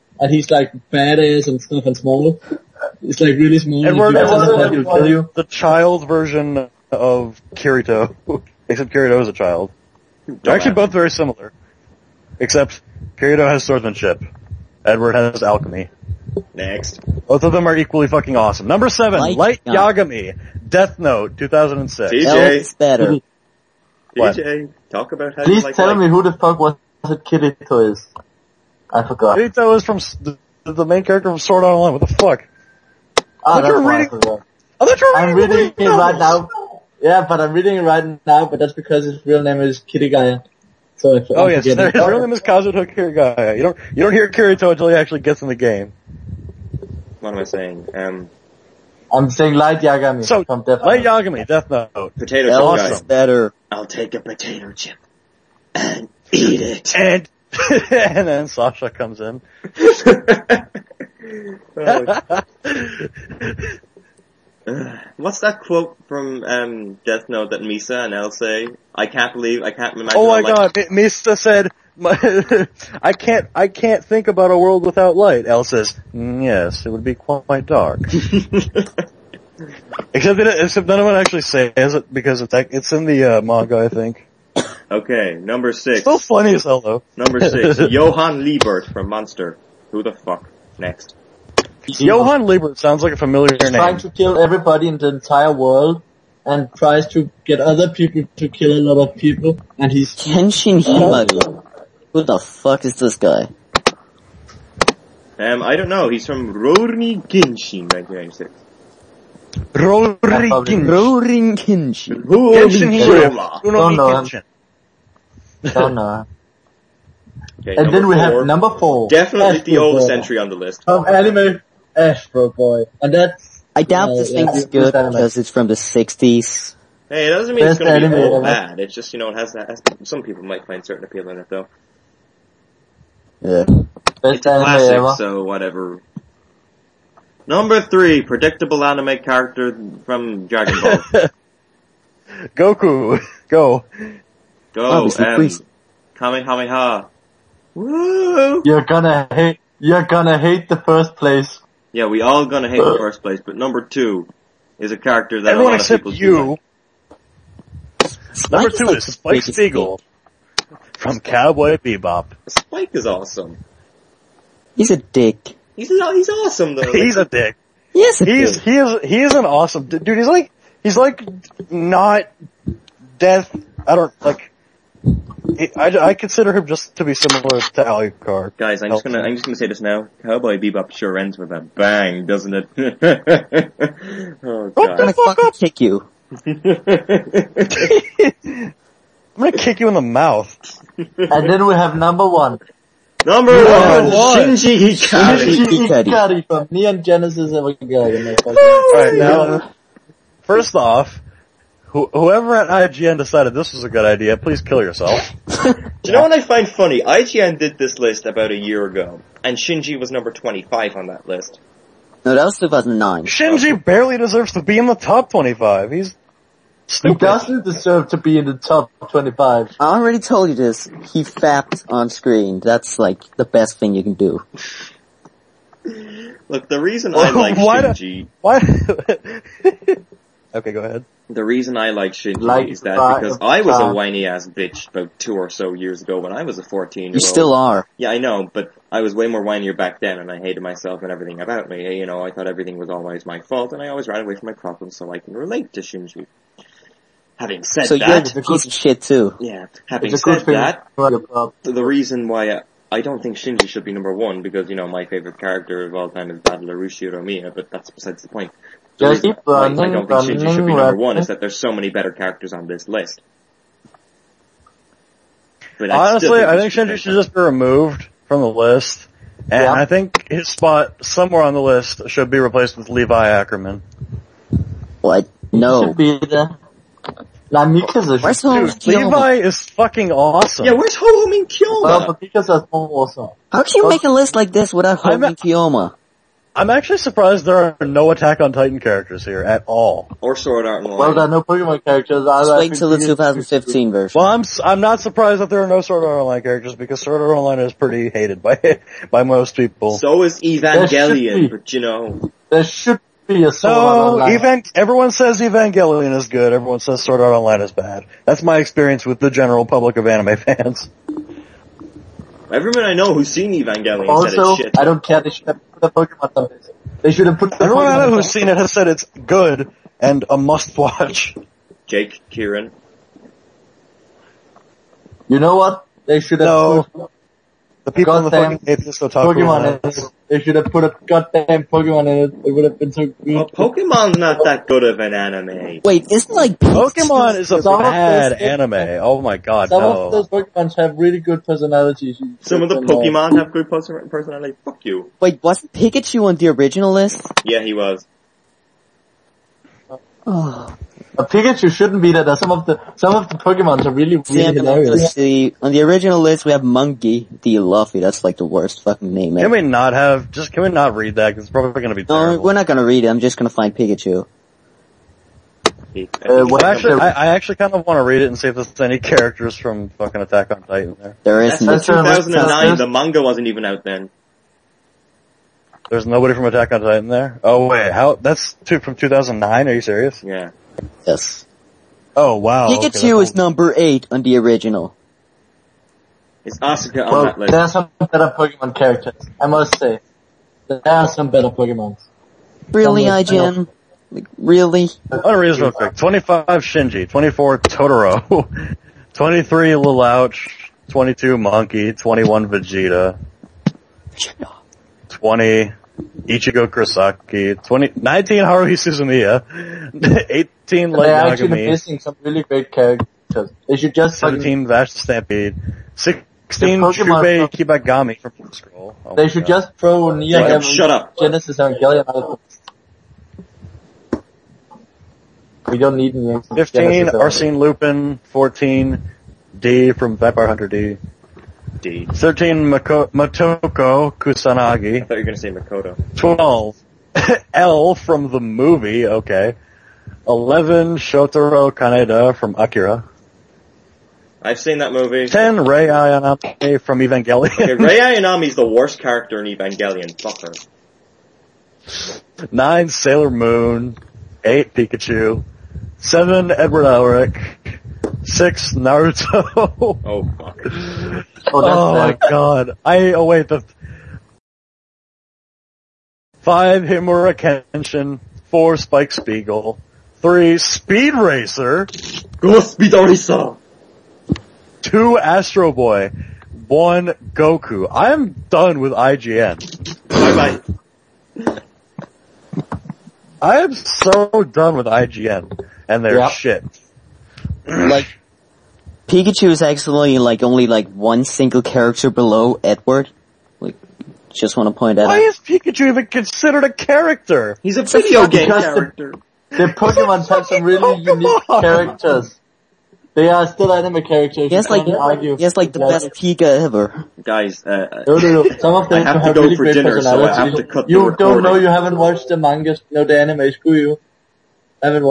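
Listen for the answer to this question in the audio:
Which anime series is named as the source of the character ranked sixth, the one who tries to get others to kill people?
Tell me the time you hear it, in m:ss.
1:29.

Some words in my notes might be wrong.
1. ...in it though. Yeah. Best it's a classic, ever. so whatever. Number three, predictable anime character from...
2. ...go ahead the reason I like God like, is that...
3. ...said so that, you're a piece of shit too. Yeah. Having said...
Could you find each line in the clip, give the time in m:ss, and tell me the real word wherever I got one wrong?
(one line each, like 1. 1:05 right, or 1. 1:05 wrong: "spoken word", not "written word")
1. 2:11 right
2. 3:50 wrong: "Shinji", not "God"
3. 4:07 right.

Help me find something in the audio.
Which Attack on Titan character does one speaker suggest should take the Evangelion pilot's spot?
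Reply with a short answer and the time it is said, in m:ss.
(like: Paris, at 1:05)
Levi Ackerman, at 4:32.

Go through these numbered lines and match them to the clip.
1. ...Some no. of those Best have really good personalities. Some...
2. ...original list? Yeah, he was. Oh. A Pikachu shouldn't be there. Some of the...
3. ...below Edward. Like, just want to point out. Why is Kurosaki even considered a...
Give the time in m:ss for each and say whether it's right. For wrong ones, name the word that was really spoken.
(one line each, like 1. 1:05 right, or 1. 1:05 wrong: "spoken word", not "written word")
1. 5:39 wrong: "Pokemon", not "Best"
2. 5:46 right
3. 8:12 wrong: "Pikachu", not "Kurosaki".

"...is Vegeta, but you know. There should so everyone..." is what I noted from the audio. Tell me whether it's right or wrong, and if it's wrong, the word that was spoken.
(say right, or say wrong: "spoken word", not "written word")
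wrong: "Evangelion", not "Vegeta".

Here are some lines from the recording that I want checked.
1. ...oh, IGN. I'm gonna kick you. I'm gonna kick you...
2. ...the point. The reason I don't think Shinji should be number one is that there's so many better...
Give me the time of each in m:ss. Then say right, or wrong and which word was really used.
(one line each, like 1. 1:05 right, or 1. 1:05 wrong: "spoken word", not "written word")
1. 3:04 wrong: "God", not "IGN"
2. 4:18 right.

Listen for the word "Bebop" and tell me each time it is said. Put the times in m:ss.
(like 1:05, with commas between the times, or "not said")
2:41, 3:00.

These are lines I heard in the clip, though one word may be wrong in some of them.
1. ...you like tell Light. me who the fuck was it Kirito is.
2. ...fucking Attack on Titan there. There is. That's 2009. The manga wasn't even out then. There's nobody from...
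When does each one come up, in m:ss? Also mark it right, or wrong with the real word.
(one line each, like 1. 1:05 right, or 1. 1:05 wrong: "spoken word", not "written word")
1. 0:25 right
2. 6:09 right.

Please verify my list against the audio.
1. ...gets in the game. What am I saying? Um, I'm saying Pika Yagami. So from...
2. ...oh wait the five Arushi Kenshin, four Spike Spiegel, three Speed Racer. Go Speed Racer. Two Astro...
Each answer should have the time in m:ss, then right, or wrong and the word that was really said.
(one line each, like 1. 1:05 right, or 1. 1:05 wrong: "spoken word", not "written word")
1. 0:45 wrong: "Light", not "Pika"
2. 7:43 wrong: "Himura", not "Arushi".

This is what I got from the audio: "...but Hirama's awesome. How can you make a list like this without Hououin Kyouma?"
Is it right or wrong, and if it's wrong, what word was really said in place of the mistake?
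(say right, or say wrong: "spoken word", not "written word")
wrong: "Mika", not "Hirama".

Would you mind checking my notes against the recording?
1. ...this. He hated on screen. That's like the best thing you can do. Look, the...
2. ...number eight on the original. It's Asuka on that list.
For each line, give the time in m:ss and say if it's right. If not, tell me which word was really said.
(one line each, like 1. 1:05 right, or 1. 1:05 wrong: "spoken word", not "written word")
1. 3:40 wrong: "fapped", not "hated"
2. 6:23 right.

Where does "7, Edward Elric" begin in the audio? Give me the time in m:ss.
7:35.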